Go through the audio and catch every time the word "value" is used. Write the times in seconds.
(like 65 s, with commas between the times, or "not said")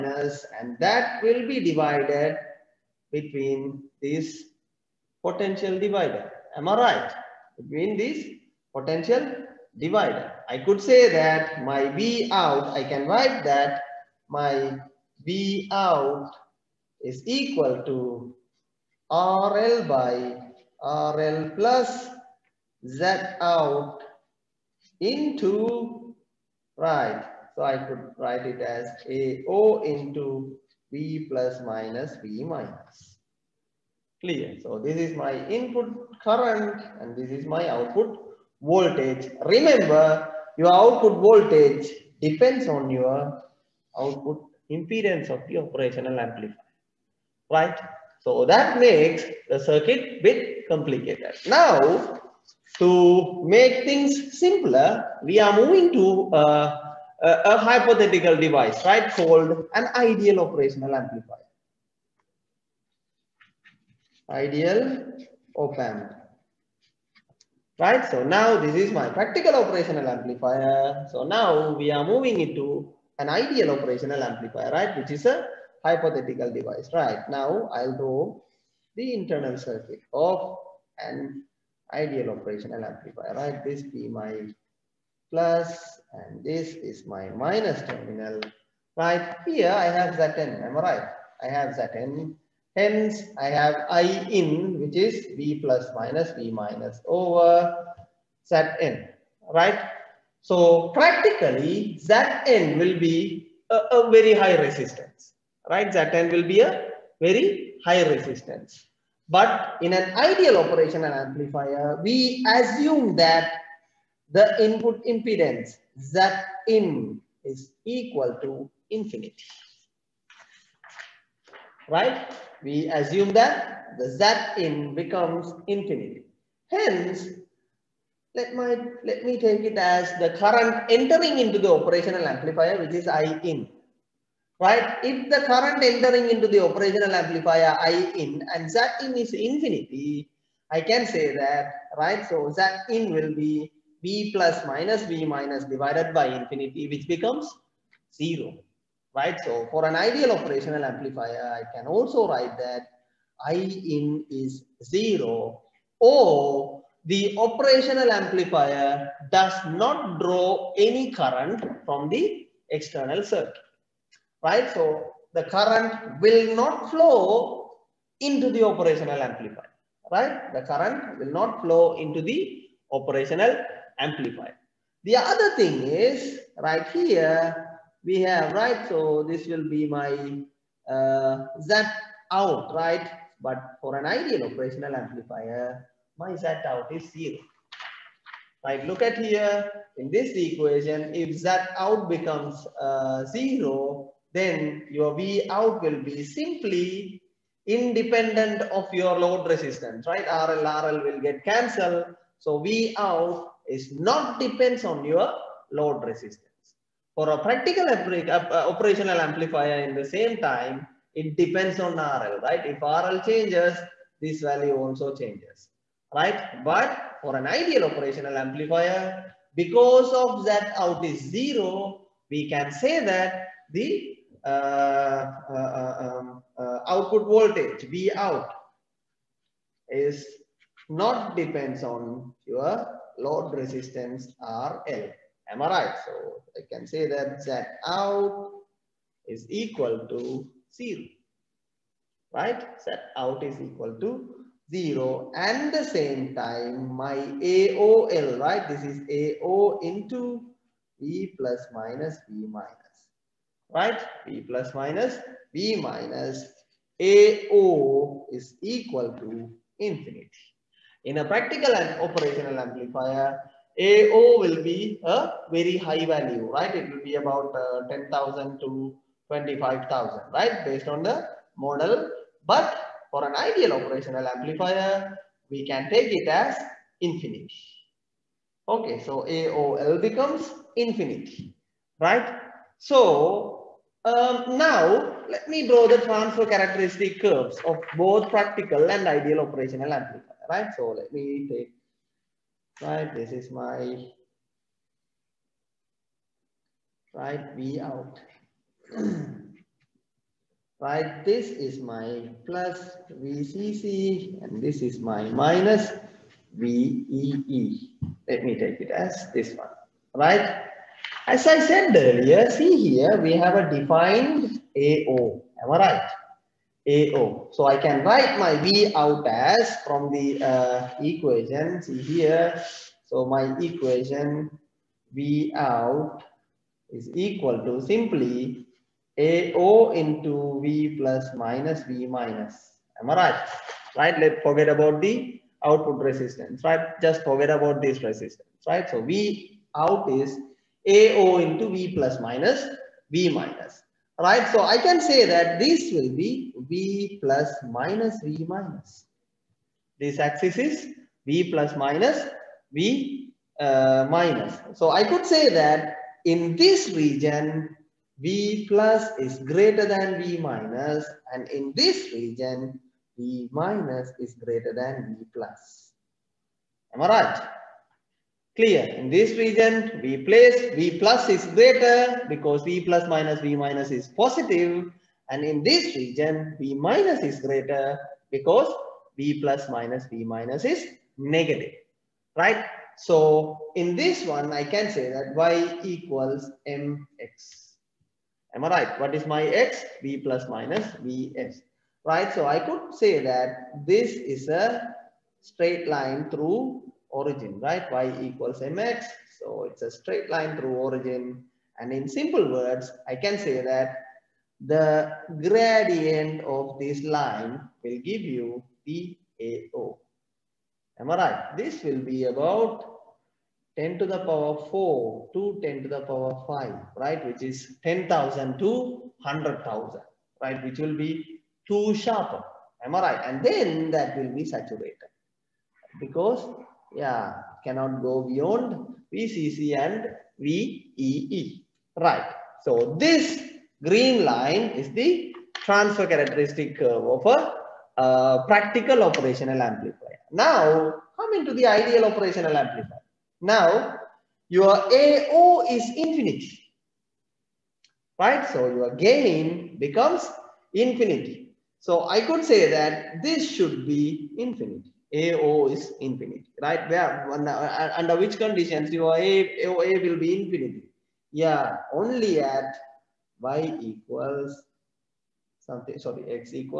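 214 s, 266 s.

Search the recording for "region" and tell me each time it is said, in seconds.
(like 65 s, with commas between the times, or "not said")
356 s, 362 s, 369 s, 375 s.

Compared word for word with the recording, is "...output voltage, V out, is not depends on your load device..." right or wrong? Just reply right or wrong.
wrong.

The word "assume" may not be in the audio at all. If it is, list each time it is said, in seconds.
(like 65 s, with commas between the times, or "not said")
112 s, 122 s.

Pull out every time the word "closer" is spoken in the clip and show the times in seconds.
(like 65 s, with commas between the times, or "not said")
not said.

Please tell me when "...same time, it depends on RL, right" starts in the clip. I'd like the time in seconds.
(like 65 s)
210 s.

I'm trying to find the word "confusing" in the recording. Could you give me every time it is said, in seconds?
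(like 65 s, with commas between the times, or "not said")
not said.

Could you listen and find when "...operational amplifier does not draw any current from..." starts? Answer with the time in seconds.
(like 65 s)
157 s.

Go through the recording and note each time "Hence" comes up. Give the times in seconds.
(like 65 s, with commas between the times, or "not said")
92 s, 126 s.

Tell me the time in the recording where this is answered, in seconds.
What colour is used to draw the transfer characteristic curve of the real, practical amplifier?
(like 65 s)
433 s.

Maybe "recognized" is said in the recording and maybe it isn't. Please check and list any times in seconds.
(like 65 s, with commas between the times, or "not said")
not said.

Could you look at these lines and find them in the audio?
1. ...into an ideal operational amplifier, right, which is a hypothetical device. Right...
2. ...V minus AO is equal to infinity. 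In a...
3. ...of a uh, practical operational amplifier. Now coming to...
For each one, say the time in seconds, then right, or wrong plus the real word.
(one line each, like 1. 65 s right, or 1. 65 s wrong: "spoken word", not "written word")
1. 72 s right
2. 255 s right
3. 437 s right.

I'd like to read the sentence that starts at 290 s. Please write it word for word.
So let me take, right, this is my, right, V out.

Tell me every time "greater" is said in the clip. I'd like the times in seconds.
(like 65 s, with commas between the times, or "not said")
359 s, 364 s, 371 s, 377 s.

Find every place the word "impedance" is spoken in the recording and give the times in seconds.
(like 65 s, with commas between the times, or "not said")
44 s, 115 s.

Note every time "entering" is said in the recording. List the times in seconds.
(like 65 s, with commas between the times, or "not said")
130 s, 135 s.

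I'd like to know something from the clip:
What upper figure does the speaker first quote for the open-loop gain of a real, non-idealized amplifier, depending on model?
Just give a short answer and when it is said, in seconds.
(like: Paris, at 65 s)
25,000, at 269 s.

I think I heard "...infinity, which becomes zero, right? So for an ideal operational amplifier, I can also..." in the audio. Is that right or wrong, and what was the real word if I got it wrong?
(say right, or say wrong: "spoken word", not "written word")
right.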